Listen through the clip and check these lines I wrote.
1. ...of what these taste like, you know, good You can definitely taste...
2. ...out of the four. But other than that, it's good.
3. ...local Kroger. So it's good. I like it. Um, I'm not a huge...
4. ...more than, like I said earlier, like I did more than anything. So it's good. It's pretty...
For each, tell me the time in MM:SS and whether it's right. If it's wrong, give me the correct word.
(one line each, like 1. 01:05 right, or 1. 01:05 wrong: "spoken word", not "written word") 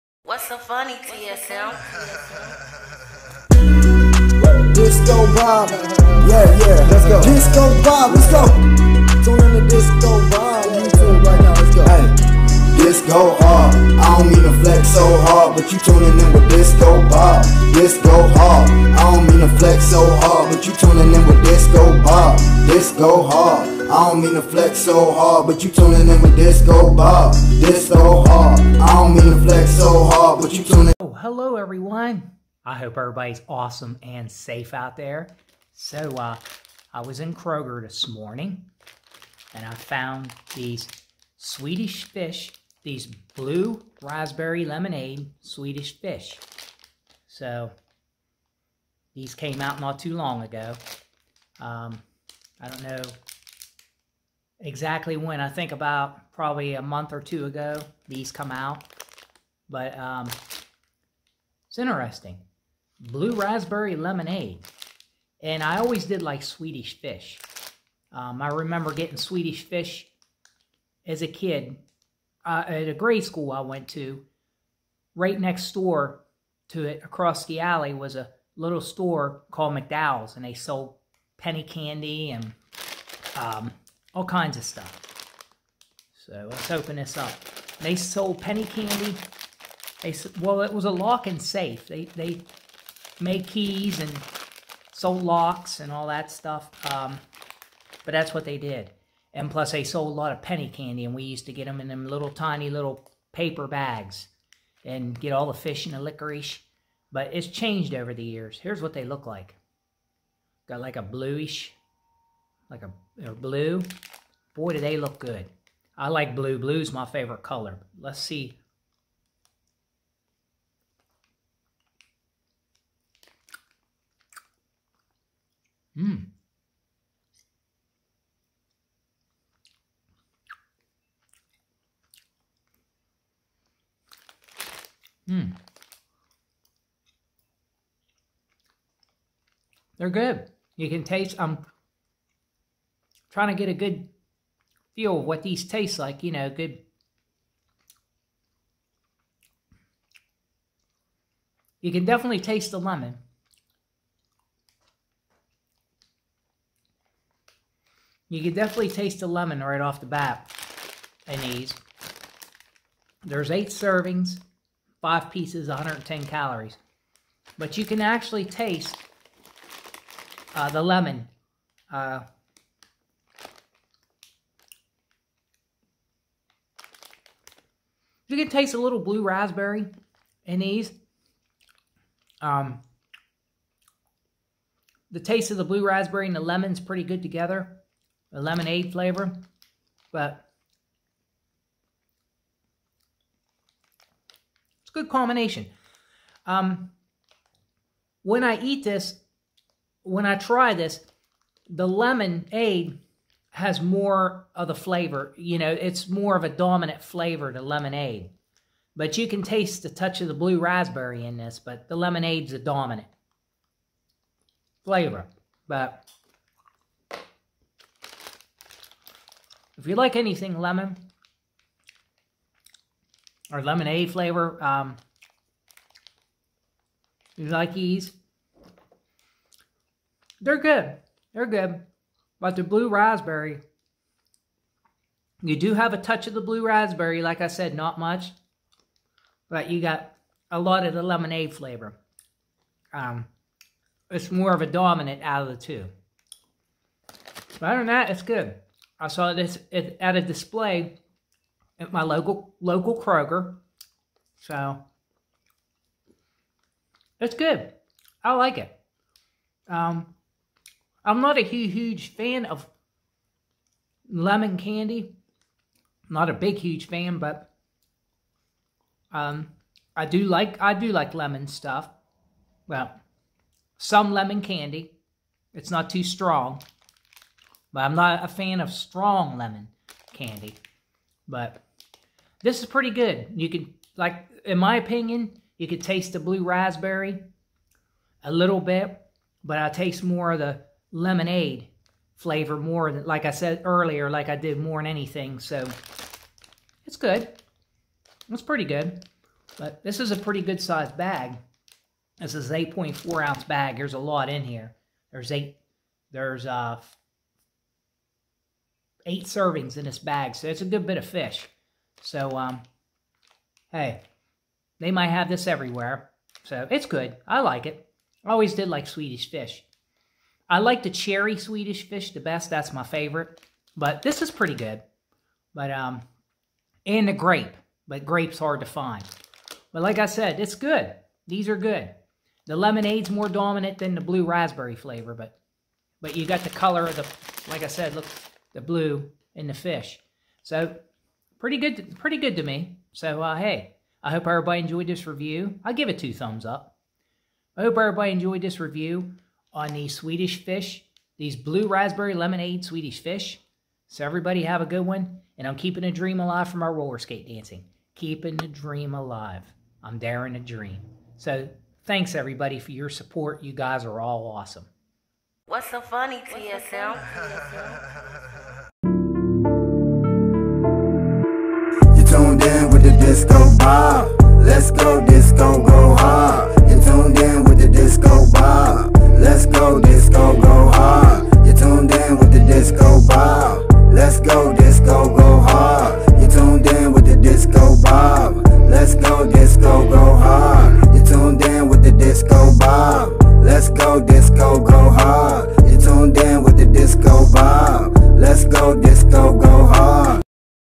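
1. 02:25 right
2. 04:05 wrong: "two", not "four"
3. 04:12 right
4. 04:52 right.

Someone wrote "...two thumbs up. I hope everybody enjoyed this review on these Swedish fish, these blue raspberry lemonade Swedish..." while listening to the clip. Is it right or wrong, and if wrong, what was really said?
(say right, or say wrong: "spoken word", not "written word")
right.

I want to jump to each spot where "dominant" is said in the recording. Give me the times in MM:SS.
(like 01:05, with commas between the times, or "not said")
03:26, 03:32, 04:04, 05:33.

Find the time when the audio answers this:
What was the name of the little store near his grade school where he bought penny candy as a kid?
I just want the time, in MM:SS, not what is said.
01:19.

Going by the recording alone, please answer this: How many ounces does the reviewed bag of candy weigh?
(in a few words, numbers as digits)
8.4.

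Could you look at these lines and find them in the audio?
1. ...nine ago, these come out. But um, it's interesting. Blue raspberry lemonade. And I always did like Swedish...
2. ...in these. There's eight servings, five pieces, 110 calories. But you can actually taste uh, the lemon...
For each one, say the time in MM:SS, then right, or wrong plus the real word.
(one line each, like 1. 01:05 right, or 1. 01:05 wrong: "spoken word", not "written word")
1. 00:57 wrong: "two", not "nine"
2. 02:41 right.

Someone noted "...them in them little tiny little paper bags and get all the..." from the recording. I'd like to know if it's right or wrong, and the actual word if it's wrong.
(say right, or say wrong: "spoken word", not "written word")
right.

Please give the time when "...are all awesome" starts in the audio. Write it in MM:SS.
06:03.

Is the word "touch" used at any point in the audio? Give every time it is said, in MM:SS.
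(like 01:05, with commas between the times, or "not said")
03:29, 03:55.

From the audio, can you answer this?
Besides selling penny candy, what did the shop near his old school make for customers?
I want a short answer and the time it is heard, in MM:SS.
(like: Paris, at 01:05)
keys, at 01:33.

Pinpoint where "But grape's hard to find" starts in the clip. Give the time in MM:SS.
05:27.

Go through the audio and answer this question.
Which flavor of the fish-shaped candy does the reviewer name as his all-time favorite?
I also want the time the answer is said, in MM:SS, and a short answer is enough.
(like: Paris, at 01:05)
cherry, at 05:20.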